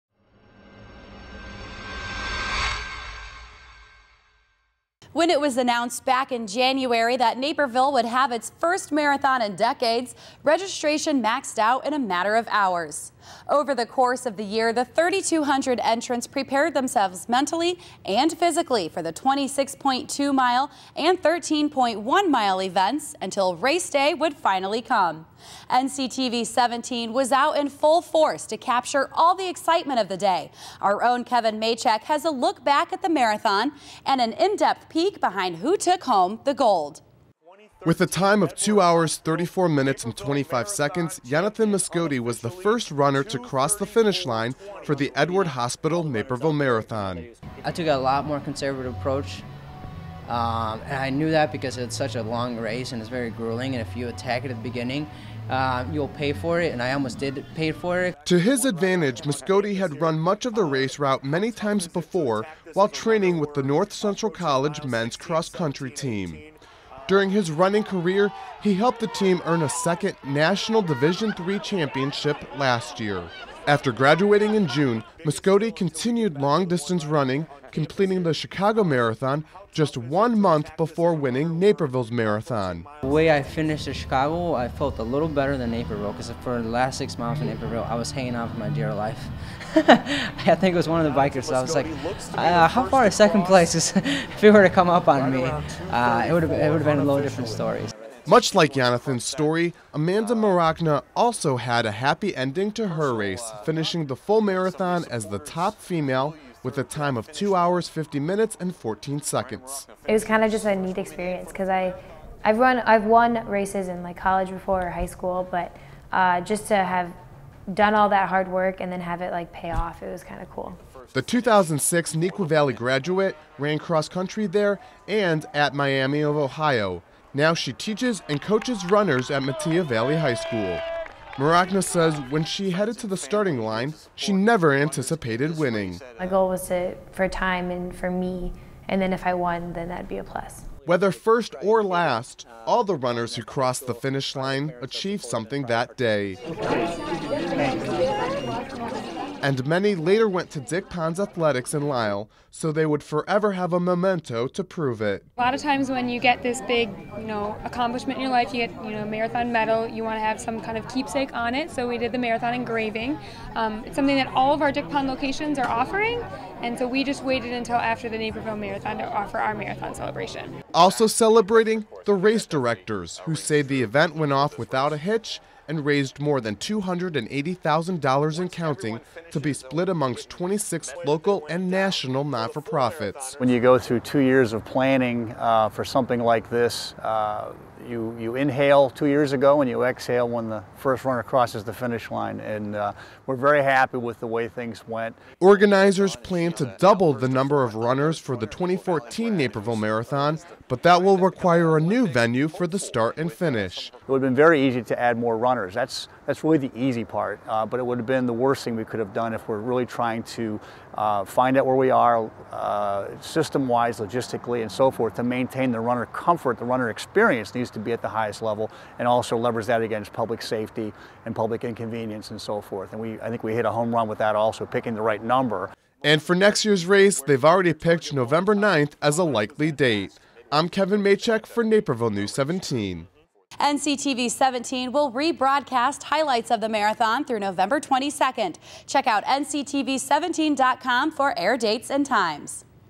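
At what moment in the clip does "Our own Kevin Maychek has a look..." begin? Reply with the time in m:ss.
0:30.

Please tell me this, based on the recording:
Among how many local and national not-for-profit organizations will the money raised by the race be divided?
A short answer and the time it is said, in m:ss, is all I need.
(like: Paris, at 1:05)
26, at 3:00.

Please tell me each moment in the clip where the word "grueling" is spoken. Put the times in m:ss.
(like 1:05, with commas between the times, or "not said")
0:53.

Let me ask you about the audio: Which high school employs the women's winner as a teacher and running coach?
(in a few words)
Metea Valley High School.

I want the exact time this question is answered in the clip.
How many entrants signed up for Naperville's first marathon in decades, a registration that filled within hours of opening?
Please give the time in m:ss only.
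0:14.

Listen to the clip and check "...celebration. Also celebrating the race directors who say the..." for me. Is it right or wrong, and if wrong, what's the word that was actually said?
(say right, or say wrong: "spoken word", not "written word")
right.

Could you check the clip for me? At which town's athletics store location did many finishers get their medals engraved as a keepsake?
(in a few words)
Lisle.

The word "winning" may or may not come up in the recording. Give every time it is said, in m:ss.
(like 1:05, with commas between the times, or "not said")
1:21, 2:15.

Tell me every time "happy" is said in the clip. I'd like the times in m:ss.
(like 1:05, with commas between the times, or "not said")
1:41, 3:13.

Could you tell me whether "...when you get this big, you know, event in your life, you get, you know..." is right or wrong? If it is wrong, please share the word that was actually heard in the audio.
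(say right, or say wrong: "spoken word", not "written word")
wrong: "accomplishment", not "event".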